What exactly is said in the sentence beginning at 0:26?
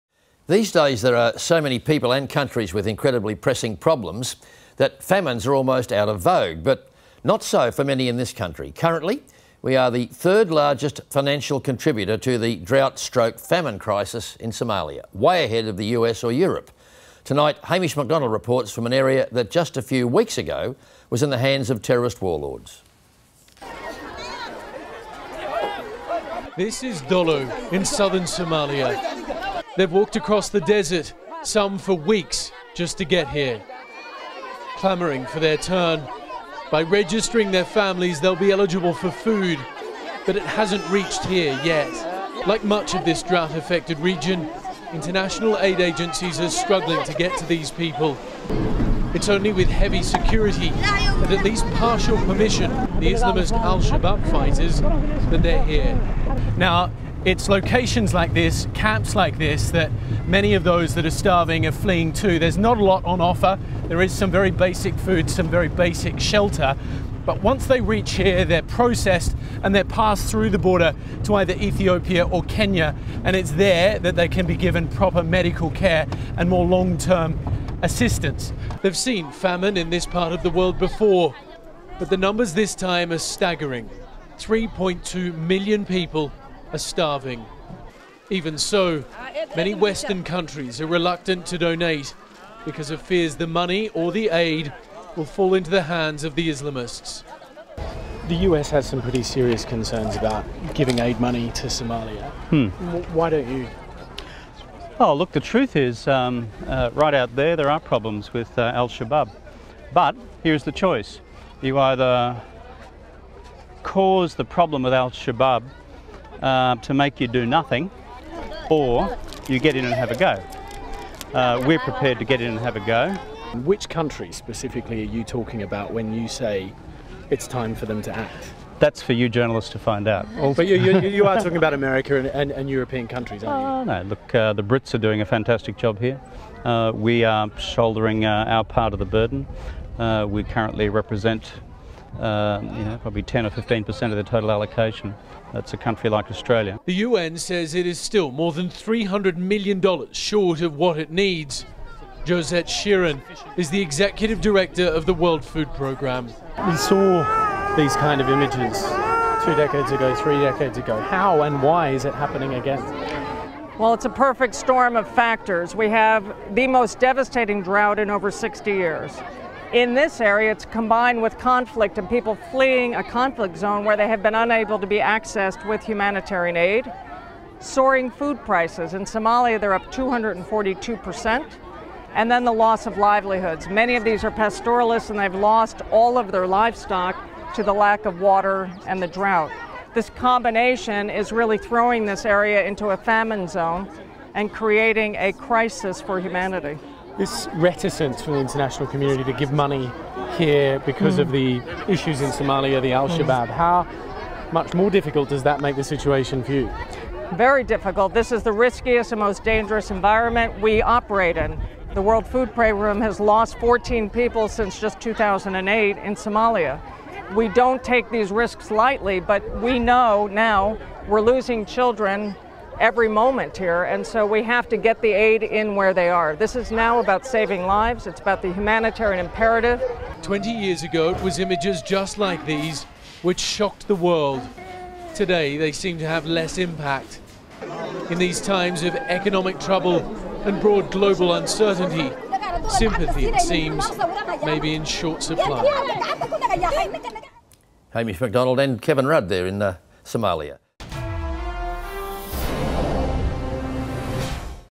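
This is Dolo in southern Somalia.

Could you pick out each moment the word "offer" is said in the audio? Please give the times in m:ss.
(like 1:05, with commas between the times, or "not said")
1:03.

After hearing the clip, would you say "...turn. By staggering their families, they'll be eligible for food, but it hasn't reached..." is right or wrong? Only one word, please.
wrong.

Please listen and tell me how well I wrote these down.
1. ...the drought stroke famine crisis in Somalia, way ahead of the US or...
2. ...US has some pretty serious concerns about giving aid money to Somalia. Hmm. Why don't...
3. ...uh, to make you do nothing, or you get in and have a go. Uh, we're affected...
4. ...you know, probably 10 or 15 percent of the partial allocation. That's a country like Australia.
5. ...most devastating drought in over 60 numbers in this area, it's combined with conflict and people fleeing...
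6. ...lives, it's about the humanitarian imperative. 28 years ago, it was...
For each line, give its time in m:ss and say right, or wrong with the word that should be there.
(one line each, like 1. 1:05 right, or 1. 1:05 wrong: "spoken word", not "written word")
1. 0:12 right
2. 1:38 right
3. 1:56 wrong: "prepared", not "affected"
4. 2:22 wrong: "total", not "partial"
5. 2:46 wrong: "years", not "numbers"
6. 3:47 wrong: "20", not "28".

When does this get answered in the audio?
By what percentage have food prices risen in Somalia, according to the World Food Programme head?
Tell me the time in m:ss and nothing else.
2:59.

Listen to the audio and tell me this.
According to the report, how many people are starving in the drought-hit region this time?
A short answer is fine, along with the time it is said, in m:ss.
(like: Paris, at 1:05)
3.2 million, at 1:24.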